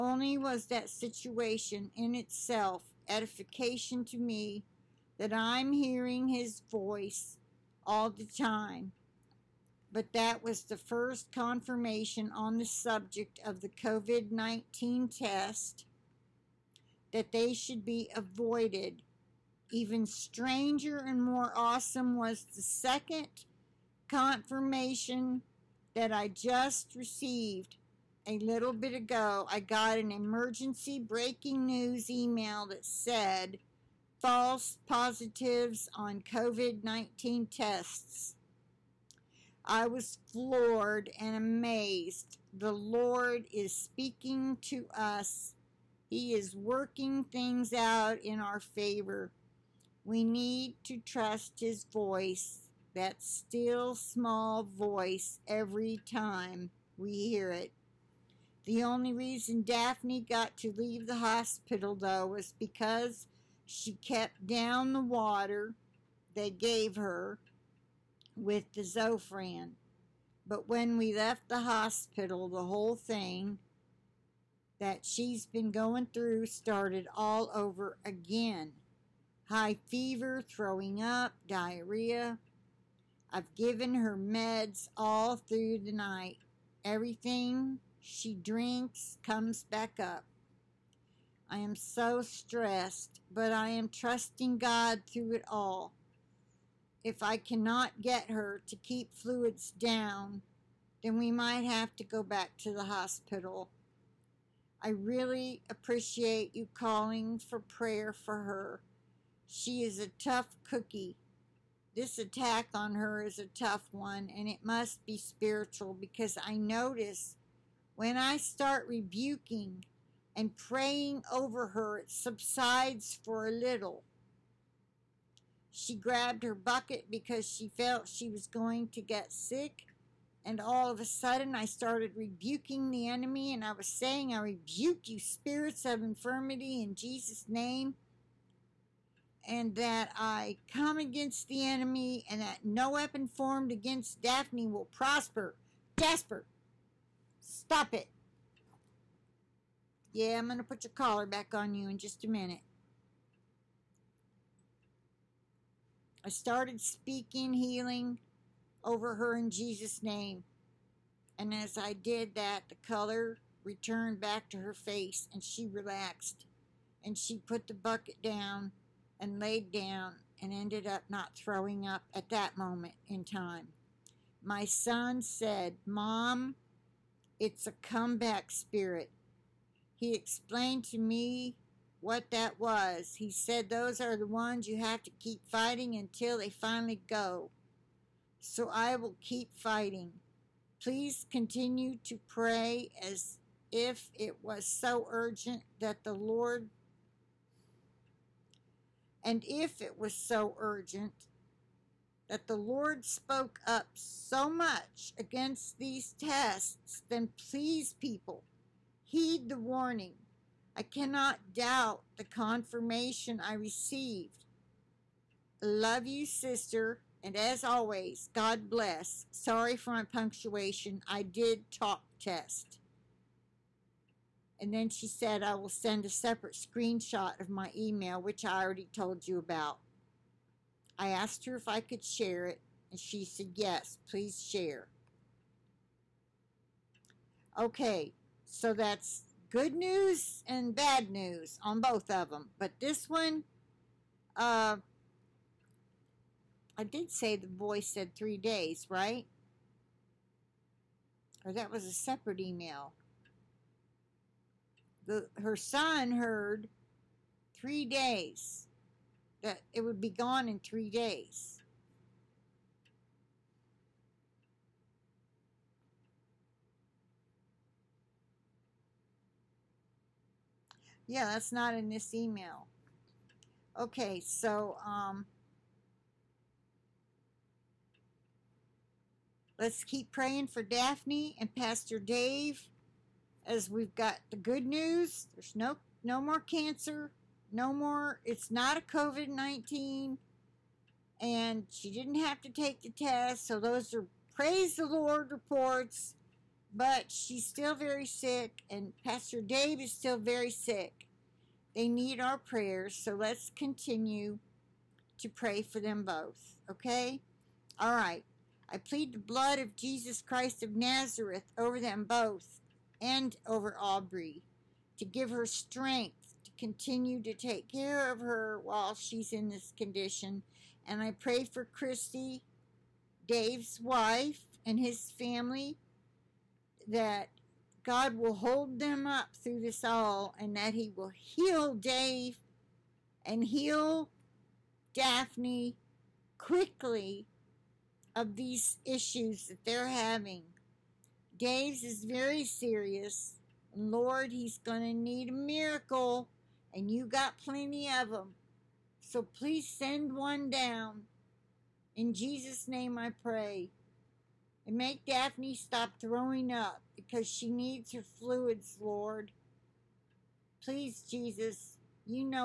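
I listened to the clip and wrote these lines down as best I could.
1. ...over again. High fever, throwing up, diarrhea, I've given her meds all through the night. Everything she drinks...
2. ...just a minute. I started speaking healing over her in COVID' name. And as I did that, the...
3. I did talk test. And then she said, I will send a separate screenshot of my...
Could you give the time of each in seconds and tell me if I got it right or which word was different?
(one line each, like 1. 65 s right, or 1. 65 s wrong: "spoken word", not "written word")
1. 77 s right
2. 151 s wrong: "Jesus", not "COVID"
3. 221 s right.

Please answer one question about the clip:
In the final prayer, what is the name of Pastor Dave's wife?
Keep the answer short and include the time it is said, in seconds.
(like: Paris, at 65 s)
Christy, at 321 s.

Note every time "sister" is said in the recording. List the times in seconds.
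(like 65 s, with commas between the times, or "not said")
216 s.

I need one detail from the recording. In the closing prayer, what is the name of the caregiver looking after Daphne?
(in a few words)
Aubrey.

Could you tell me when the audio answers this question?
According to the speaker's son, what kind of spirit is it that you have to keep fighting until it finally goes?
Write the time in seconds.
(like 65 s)
177 s.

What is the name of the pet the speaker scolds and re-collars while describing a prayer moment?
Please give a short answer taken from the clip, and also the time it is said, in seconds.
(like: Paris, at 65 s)
Jasper, at 145 s.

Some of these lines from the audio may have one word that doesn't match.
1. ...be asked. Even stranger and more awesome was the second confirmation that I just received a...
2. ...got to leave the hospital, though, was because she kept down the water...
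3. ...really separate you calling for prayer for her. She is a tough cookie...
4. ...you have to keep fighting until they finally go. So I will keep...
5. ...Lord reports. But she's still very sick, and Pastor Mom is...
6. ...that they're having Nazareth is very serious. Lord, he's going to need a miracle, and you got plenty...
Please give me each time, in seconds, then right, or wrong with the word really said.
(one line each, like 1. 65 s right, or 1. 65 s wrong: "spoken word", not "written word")
1. 17 s wrong: "avoided", not "asked"
2. 60 s right
3. 104 s wrong: "appreciate", not "separate"
4. 184 s right
5. 294 s wrong: "Dave", not "Mom"
6. 339 s wrong: "James", not "Nazareth".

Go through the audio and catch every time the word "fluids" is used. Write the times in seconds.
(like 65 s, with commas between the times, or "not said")
99 s, 358 s.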